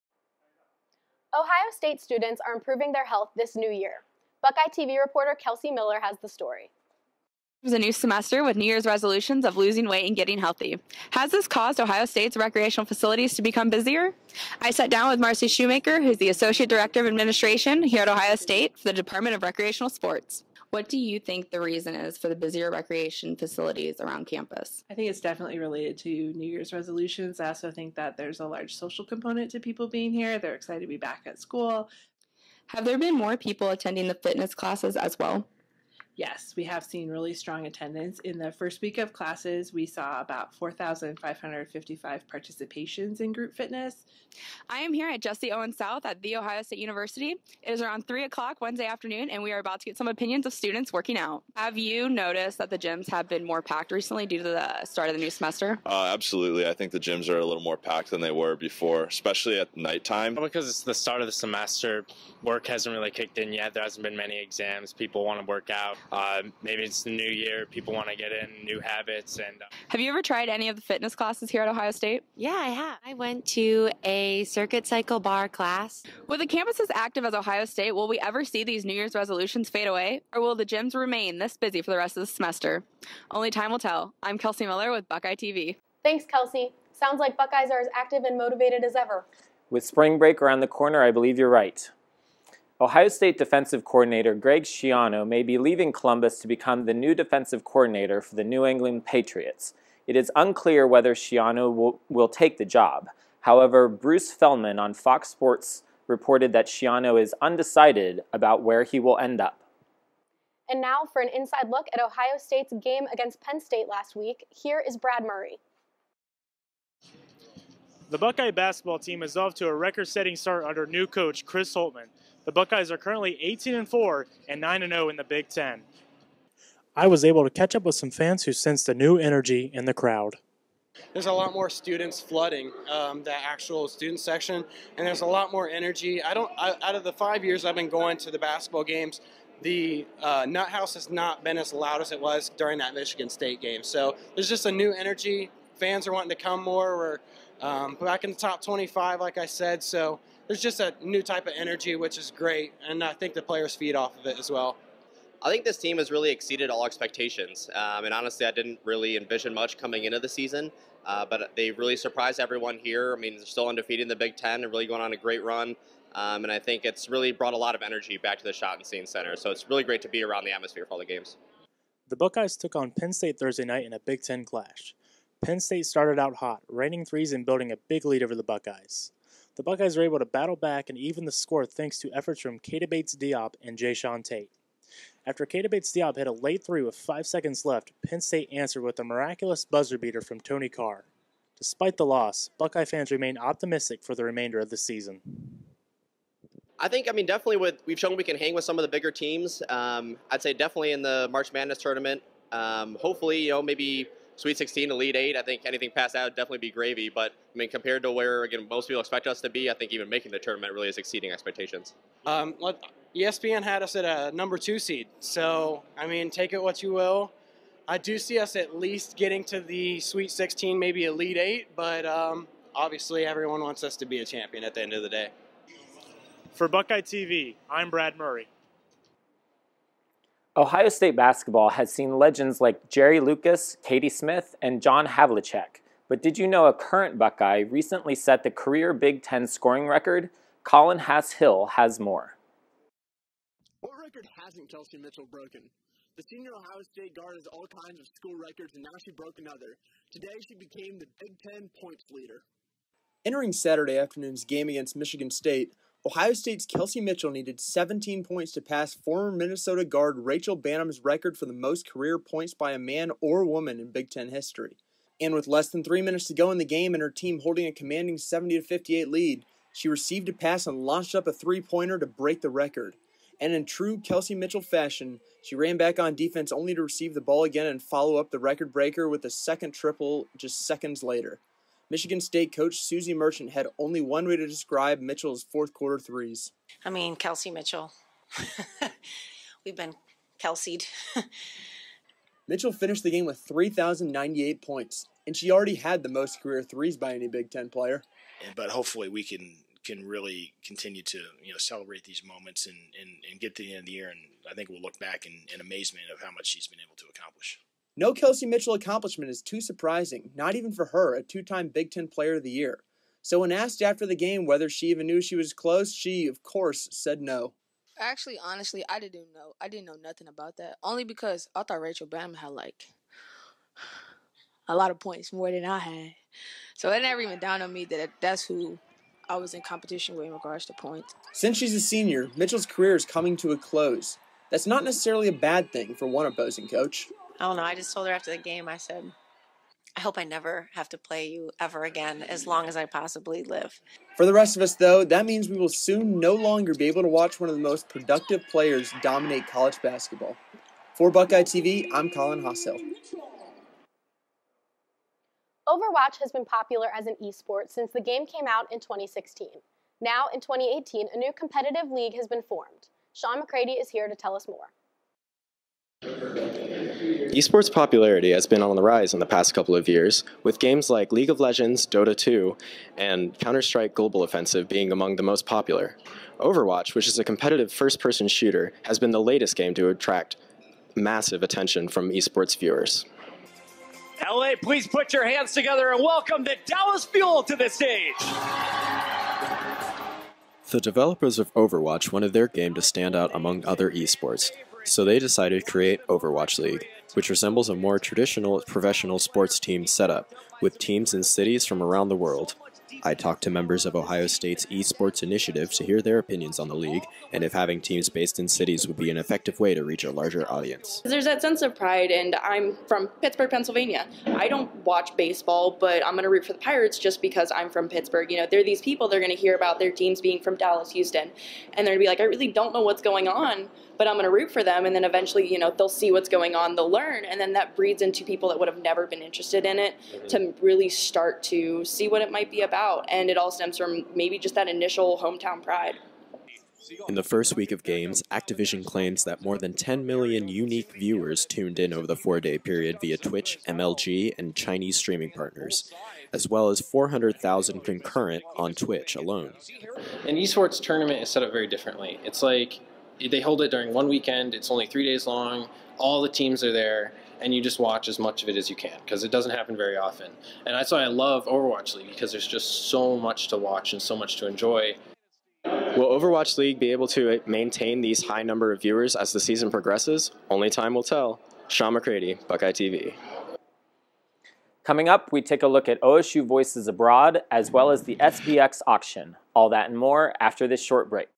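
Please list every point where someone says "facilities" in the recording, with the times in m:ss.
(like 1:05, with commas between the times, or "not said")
0:12, 0:23.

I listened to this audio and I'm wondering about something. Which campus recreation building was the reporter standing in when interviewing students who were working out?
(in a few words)
Jesse Owens South.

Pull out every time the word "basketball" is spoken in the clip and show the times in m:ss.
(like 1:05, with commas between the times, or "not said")
1:58, 2:18, 3:51, 5:49.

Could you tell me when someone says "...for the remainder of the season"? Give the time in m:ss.
3:14.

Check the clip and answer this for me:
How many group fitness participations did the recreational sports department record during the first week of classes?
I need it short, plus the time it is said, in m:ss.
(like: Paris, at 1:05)
4,555, at 0:40.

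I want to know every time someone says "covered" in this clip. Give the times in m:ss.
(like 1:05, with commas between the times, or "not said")
not said.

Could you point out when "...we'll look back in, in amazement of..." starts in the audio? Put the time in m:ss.
5:04.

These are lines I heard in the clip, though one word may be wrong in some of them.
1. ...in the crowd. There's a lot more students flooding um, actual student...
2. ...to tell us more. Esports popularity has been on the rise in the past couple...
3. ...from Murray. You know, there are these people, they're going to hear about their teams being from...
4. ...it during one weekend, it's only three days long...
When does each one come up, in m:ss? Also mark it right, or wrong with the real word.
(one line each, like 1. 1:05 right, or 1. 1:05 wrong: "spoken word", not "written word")
1. 2:09 right
2. 6:04 right
3. 6:57 wrong: "Pittsburgh", not "Murray"
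4. 7:33 right.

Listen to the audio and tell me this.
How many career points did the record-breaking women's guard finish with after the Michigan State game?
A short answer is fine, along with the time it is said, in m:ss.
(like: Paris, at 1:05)
3,098, at 4:53.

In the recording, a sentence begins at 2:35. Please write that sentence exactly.
I think this team has really exceeded all expectations.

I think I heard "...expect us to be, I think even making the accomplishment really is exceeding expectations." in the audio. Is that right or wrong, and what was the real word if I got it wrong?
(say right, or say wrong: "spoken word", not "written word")
wrong: "tournament", not "accomplishment".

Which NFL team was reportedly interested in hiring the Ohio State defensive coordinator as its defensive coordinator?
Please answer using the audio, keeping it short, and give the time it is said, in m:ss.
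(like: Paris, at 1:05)
New England Patriots, at 1:38.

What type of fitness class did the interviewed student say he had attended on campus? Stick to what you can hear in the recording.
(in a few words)
circuit cycle bar class.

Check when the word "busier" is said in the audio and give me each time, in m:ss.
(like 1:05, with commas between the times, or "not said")
0:13, 0:22.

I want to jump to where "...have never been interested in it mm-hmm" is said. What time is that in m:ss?
7:08.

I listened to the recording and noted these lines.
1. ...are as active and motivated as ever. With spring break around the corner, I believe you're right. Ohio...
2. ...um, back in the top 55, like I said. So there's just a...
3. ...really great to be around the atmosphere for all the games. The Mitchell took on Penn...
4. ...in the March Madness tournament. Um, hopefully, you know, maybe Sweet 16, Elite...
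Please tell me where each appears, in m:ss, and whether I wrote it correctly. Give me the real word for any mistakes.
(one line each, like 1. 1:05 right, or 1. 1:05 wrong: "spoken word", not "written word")
1. 1:27 right
2. 2:27 wrong: "25", not "55"
3. 2:49 wrong: "Buckeyes", not "Mitchell"
4. 3:20 right.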